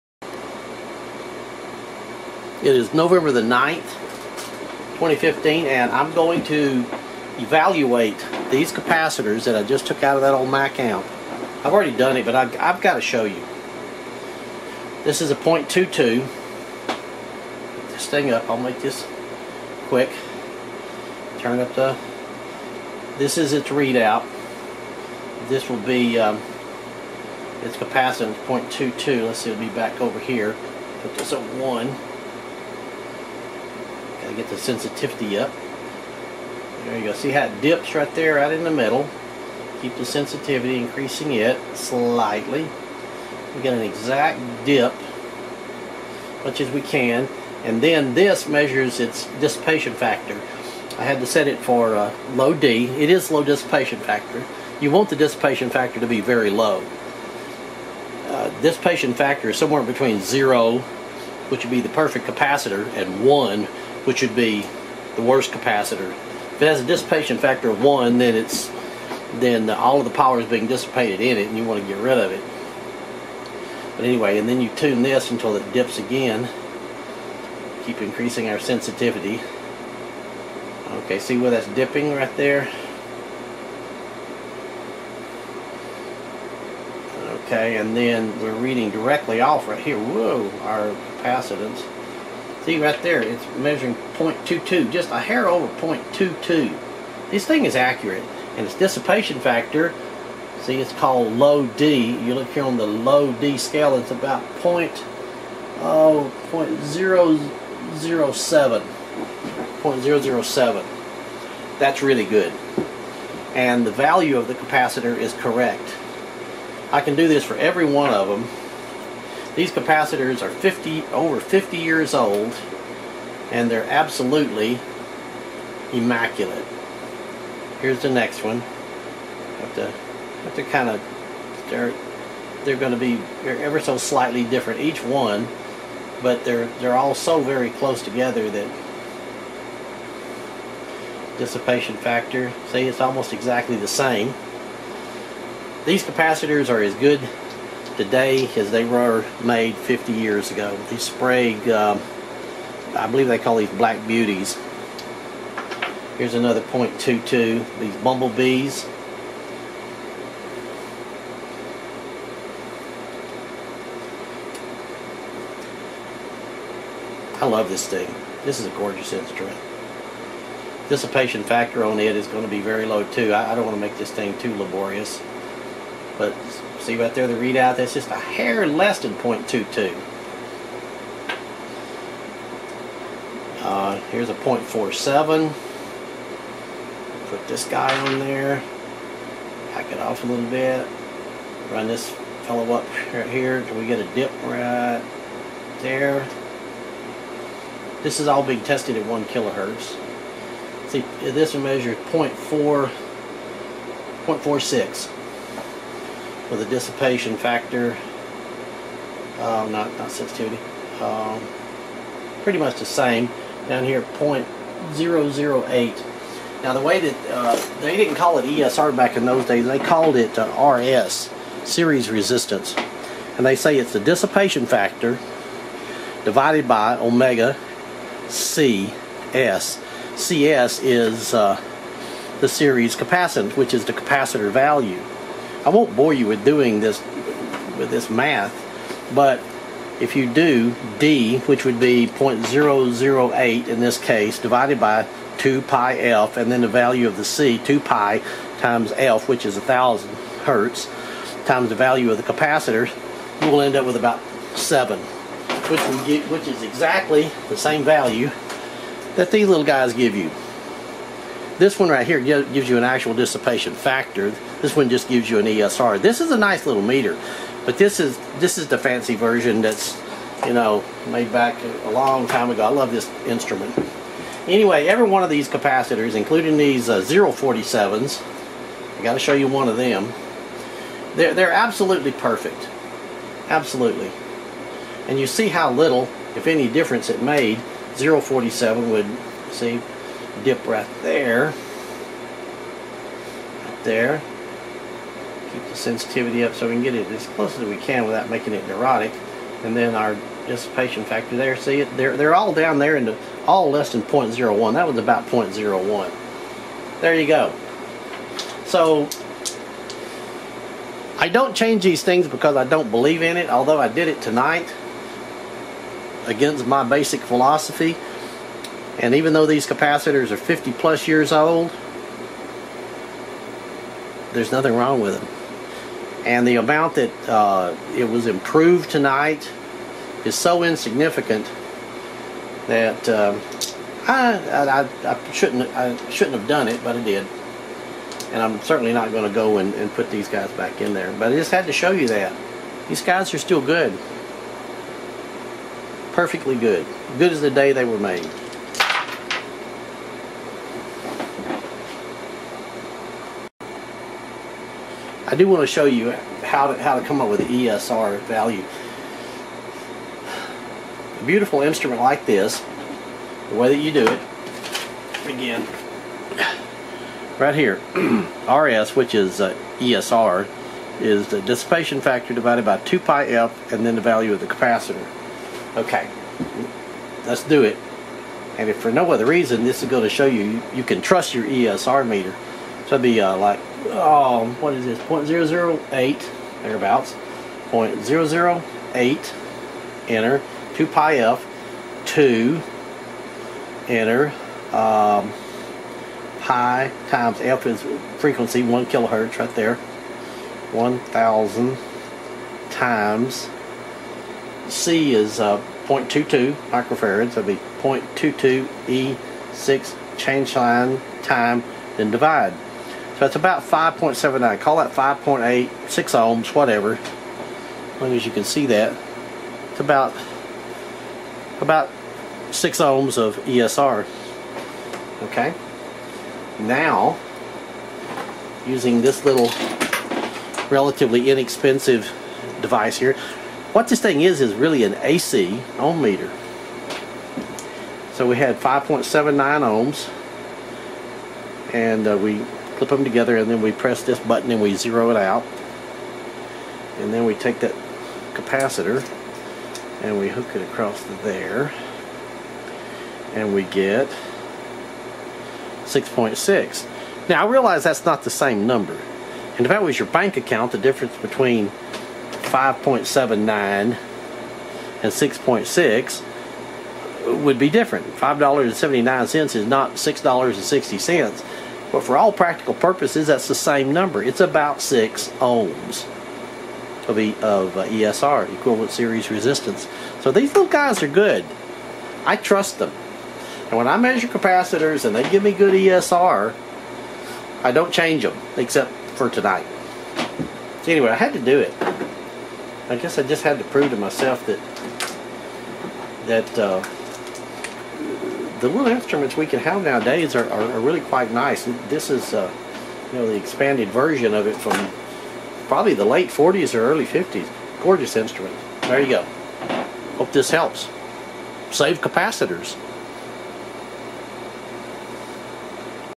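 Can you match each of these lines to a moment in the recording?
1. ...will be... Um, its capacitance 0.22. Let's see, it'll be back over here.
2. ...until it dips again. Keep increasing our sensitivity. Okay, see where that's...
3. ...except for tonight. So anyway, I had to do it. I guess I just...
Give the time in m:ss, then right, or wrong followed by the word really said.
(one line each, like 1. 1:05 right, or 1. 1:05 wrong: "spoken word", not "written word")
1. 0:25 right
2. 1:15 right
3. 8:08 right.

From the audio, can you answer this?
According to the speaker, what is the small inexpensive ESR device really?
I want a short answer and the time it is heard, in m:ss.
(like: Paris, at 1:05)
an AC ohm meter, at 7:14.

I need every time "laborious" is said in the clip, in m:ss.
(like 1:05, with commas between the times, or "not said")
2:54.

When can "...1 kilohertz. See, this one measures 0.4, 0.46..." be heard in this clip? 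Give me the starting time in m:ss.
3:19.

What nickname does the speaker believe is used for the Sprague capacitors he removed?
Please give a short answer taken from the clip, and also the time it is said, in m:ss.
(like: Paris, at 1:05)
Black Beauties, at 2:33.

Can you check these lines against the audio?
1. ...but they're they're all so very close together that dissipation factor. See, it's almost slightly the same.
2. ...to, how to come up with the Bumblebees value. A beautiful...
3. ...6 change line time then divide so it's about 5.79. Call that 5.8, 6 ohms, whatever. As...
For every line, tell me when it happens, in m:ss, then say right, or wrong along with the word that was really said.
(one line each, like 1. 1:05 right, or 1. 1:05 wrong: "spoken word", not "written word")
1. 2:16 wrong: "exactly", not "slightly"
2. 5:56 wrong: "ESR", not "Bumblebees"
3. 6:49 right.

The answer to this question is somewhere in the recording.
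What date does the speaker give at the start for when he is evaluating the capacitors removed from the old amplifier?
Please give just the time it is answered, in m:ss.
0:02.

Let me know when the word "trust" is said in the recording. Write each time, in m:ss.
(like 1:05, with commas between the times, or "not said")
6:21, 8:02.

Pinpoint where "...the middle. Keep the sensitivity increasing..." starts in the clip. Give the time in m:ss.
0:38.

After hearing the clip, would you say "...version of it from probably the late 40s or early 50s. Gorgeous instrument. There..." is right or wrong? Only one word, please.
right.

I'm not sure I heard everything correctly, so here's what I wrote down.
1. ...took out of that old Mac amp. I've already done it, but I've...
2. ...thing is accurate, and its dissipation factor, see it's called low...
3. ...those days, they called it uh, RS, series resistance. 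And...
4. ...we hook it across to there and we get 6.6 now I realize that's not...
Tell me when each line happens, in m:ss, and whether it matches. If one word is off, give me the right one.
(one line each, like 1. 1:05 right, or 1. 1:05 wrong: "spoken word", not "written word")
1. 0:09 right
2. 1:37 right
3. 3:39 right
4. 7:30 right.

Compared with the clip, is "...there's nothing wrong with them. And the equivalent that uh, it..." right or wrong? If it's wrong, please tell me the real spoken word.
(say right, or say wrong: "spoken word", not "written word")
wrong: "amount", not "equivalent".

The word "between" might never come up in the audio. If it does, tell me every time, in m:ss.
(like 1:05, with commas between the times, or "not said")
0:59, 7:41.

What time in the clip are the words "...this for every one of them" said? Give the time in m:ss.
1:57.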